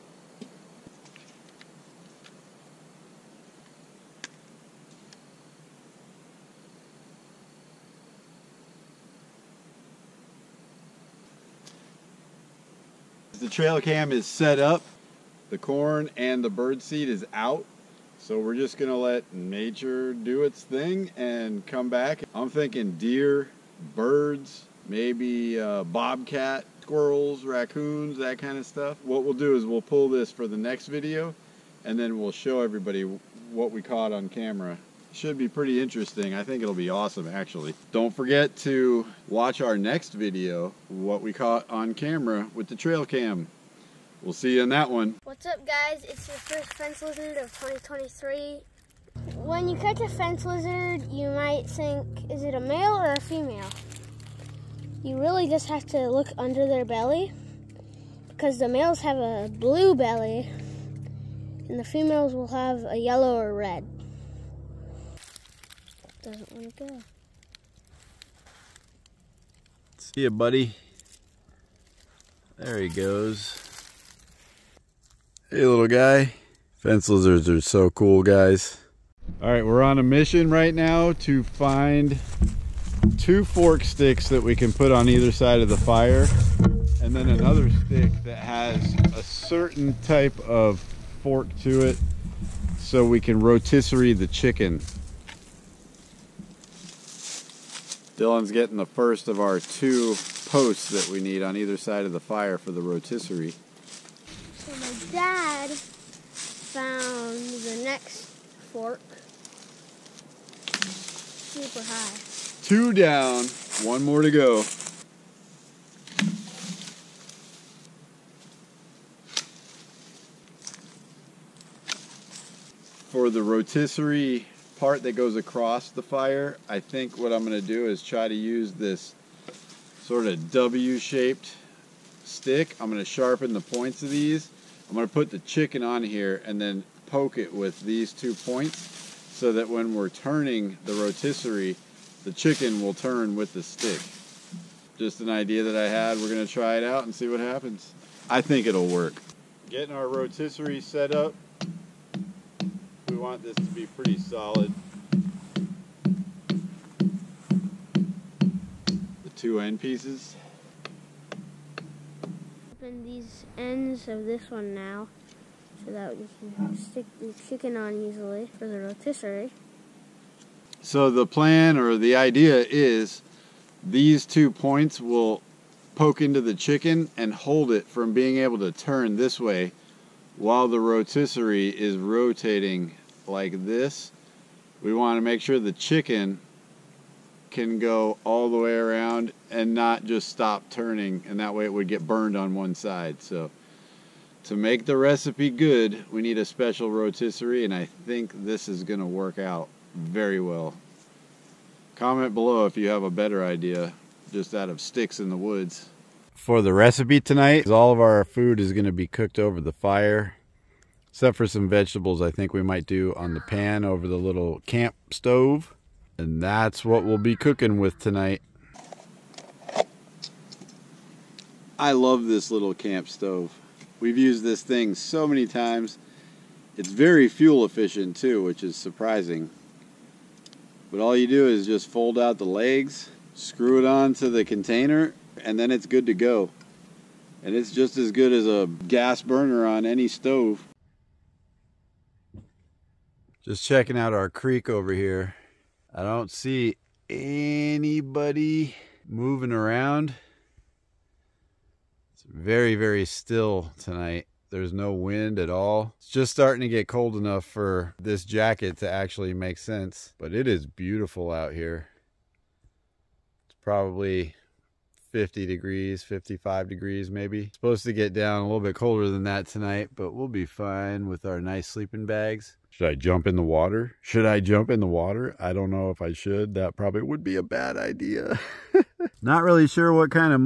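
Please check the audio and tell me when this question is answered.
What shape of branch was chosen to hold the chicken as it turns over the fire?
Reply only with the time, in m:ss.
2:10.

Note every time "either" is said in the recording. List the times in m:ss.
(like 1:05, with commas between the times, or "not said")
1:25, 1:41.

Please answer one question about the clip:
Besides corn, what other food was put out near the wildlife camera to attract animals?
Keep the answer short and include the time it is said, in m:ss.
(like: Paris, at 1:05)
Bird seed, at 0:16.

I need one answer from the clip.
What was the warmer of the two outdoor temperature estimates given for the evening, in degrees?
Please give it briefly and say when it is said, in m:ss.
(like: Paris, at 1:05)
55, at 4:26.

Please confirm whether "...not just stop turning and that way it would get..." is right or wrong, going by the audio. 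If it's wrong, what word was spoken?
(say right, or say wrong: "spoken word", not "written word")
right.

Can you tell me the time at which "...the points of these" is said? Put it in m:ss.
2:13.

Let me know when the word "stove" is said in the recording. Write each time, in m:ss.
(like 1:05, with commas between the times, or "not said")
3:35, 3:43, 4:00.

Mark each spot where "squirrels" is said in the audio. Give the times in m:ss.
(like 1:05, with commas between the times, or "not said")
0:26.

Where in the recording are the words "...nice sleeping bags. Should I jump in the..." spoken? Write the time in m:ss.
4:31.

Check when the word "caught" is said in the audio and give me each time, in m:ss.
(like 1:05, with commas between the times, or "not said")
0:33, 0:41.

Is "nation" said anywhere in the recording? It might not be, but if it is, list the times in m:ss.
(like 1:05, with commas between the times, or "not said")
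not said.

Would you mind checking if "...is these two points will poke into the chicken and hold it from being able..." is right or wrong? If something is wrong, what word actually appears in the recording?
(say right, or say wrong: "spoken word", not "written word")
right.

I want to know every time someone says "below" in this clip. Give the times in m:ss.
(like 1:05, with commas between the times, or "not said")
3:22.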